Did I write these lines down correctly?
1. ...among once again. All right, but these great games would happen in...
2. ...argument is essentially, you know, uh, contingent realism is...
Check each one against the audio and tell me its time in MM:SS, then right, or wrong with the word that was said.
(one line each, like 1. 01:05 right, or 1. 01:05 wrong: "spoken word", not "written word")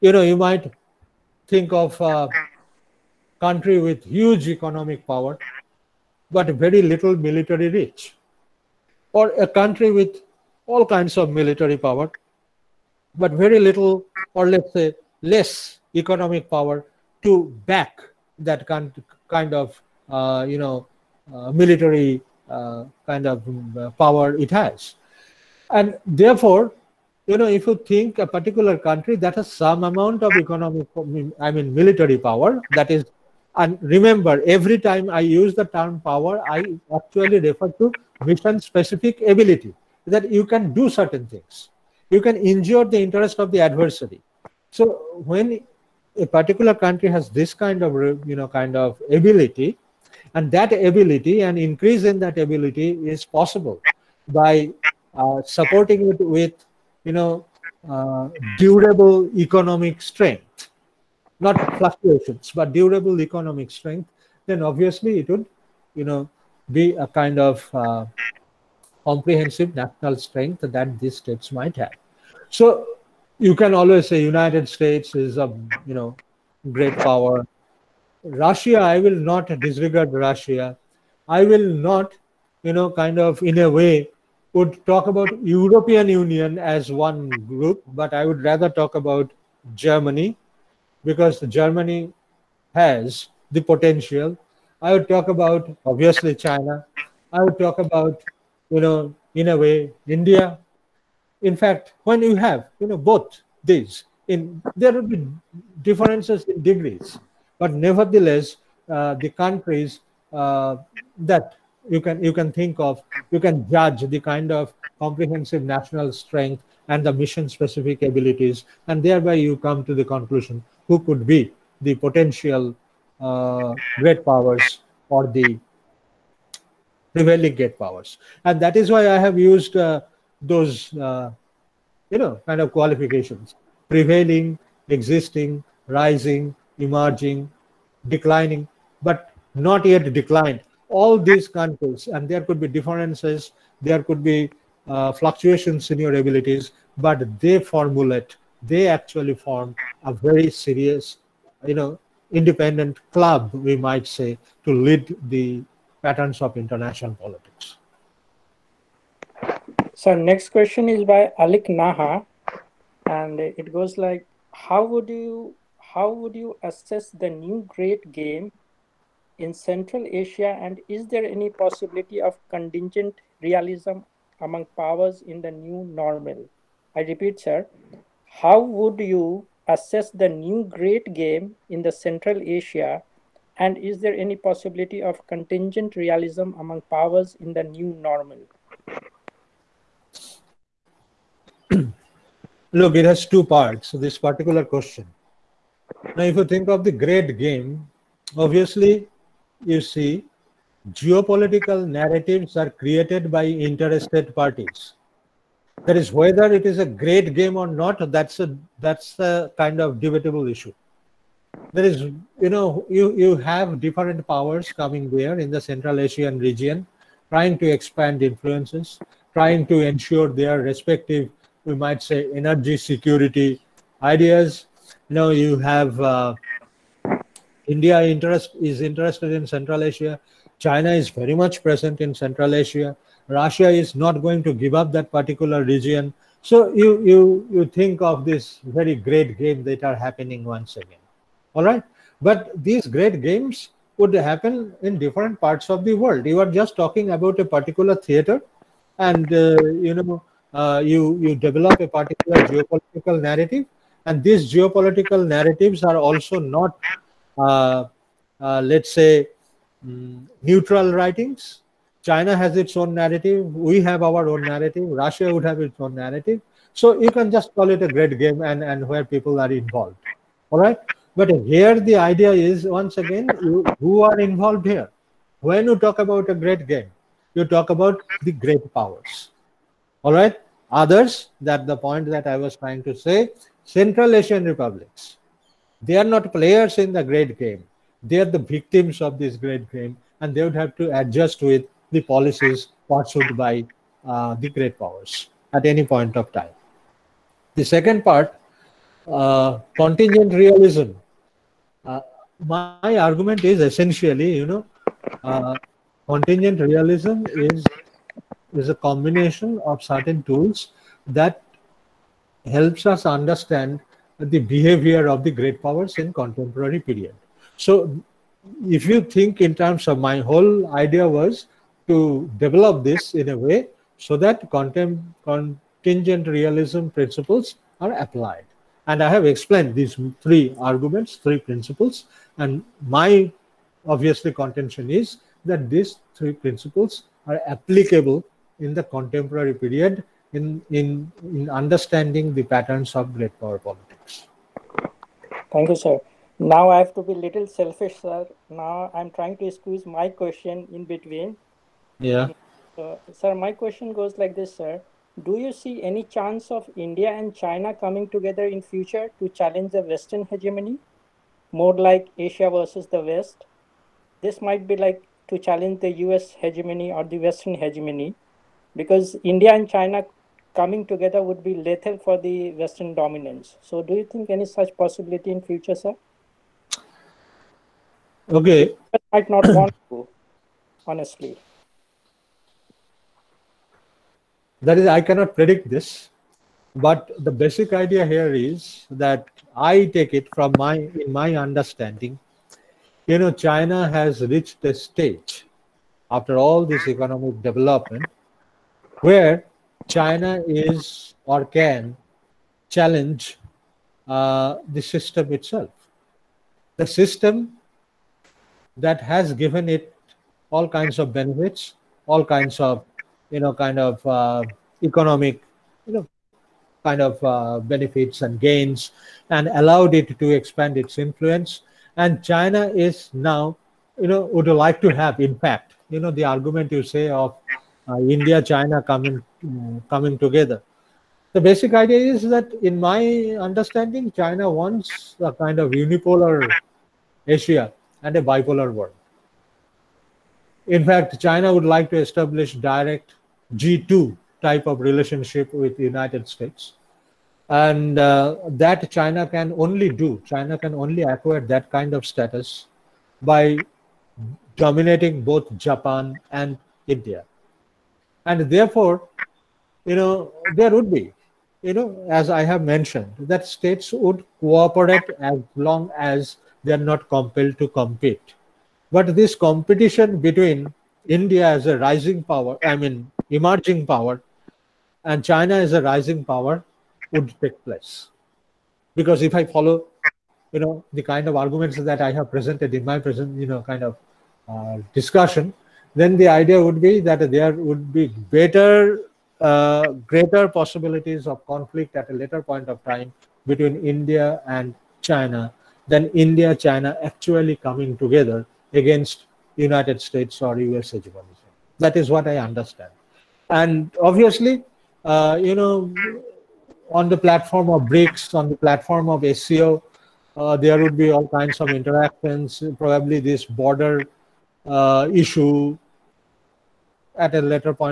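1. 03:59 wrong: "happening", not "among"
2. 05:02 right.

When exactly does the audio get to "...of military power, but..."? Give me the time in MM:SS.
00:11.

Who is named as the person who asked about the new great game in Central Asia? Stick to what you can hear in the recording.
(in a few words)
Alik Naha.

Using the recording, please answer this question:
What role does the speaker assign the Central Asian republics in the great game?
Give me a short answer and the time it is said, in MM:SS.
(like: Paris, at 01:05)
Victims, at 04:48.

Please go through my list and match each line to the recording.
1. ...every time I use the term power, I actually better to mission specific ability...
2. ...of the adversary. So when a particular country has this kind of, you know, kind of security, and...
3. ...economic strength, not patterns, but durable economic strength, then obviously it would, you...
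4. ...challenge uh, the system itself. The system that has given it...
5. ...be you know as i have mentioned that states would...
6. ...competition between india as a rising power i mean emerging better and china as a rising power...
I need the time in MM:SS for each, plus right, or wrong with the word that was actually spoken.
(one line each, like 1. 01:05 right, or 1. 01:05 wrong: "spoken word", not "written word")
1. 00:34 wrong: "refer", not "better"
2. 00:43 wrong: "ability", not "security"
3. 00:59 wrong: "fluctuations", not "patterns"
4. 06:42 right
5. 07:40 right
6. 07:49 wrong: "power", not "better".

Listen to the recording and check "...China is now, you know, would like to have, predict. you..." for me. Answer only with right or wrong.
wrong.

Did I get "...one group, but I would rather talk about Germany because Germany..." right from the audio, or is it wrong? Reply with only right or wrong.
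right.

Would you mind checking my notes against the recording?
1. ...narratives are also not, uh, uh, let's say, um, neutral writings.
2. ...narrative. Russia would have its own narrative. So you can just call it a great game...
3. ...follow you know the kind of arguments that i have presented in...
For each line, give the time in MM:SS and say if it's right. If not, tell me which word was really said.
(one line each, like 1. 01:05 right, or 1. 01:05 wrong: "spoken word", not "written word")
1. 04:15 right
2. 04:24 right
3. 07:59 right.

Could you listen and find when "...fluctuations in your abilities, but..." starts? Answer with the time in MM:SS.
02:25.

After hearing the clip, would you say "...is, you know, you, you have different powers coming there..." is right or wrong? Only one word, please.
right.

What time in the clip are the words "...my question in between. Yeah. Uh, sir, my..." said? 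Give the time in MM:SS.
05:49.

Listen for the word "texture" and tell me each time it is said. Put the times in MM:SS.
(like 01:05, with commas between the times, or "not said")
not said.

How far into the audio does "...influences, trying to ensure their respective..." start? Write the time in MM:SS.
03:38.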